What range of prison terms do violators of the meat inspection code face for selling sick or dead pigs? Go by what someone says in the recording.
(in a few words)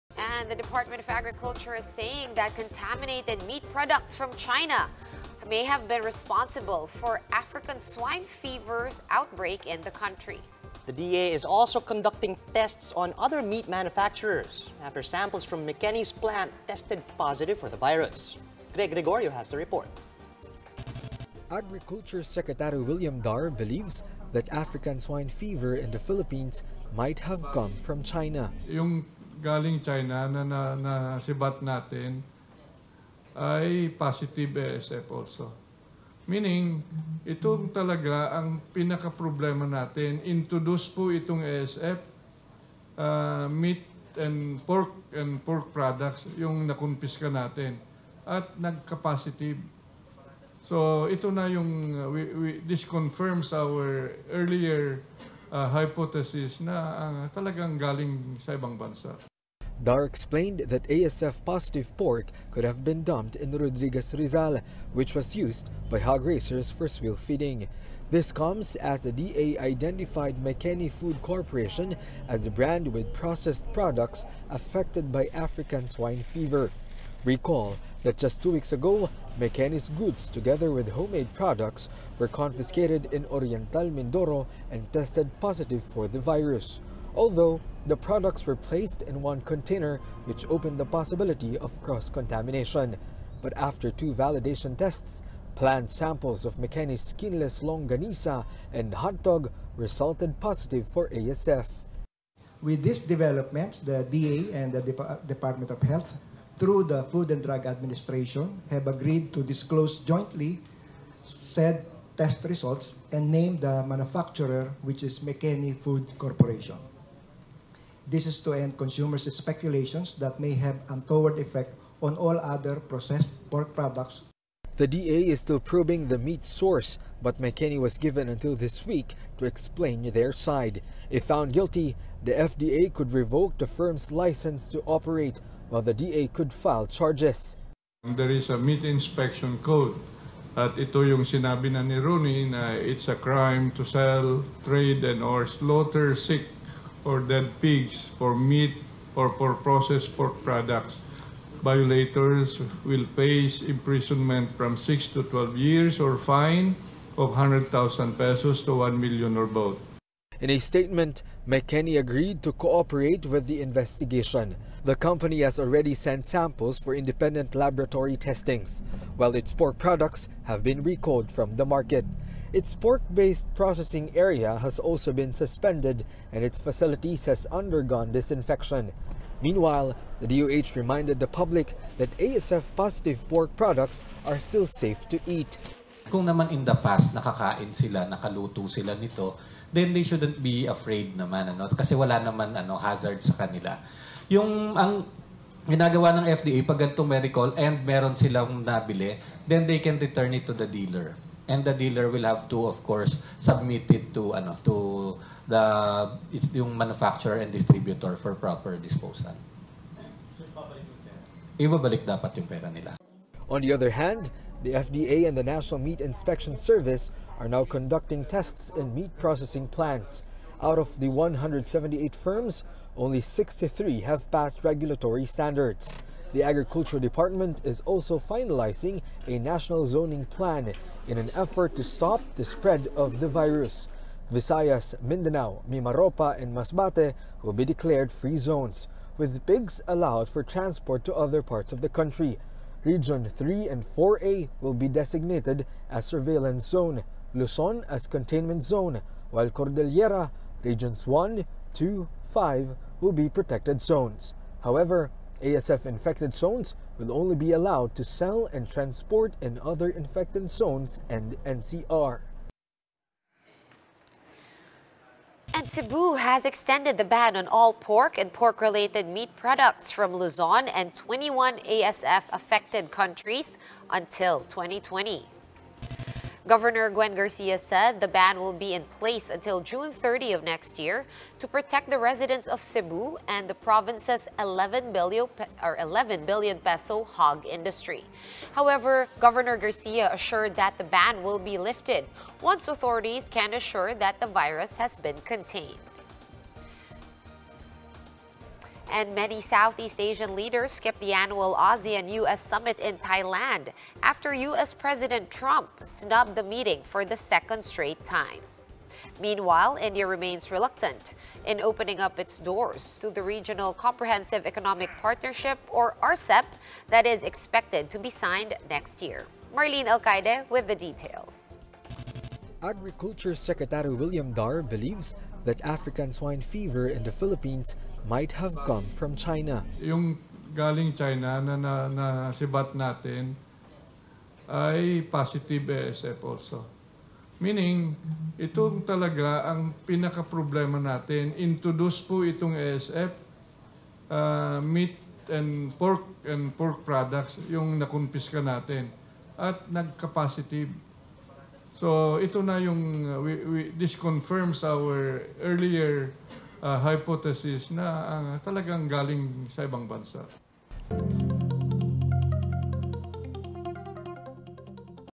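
6 to 12 years.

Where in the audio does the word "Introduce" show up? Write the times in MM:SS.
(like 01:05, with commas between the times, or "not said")
00:40, 05:41.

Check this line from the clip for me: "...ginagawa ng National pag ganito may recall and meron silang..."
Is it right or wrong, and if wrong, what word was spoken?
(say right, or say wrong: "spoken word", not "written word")
wrong: "FDA", not "National".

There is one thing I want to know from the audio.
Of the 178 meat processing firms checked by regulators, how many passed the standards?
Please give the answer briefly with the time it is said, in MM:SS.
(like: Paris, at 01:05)
63, at 03:43.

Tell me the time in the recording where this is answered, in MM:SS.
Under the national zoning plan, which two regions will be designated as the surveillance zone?
04:02.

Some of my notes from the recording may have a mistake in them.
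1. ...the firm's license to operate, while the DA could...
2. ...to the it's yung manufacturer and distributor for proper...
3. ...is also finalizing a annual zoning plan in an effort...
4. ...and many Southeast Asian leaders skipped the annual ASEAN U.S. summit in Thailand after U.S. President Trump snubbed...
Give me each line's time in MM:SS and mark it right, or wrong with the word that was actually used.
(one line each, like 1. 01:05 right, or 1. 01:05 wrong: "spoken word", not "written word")
1. 02:13 right
2. 03:24 right
3. 03:47 wrong: "national", not "annual"
4. 04:58 right.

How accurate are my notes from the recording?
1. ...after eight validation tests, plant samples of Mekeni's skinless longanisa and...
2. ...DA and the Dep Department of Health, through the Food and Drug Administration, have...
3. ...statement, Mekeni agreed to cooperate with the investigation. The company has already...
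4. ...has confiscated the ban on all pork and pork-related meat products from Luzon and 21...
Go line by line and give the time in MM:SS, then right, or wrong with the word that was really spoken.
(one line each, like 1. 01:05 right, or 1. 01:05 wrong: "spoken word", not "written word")
1. 01:33 wrong: "two", not "eight"
2. 01:44 right
3. 02:40 right
4. 04:26 wrong: "extended", not "confiscated".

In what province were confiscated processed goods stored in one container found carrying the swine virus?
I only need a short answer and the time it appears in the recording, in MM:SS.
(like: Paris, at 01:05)
Oriental Mindoro, at 01:23.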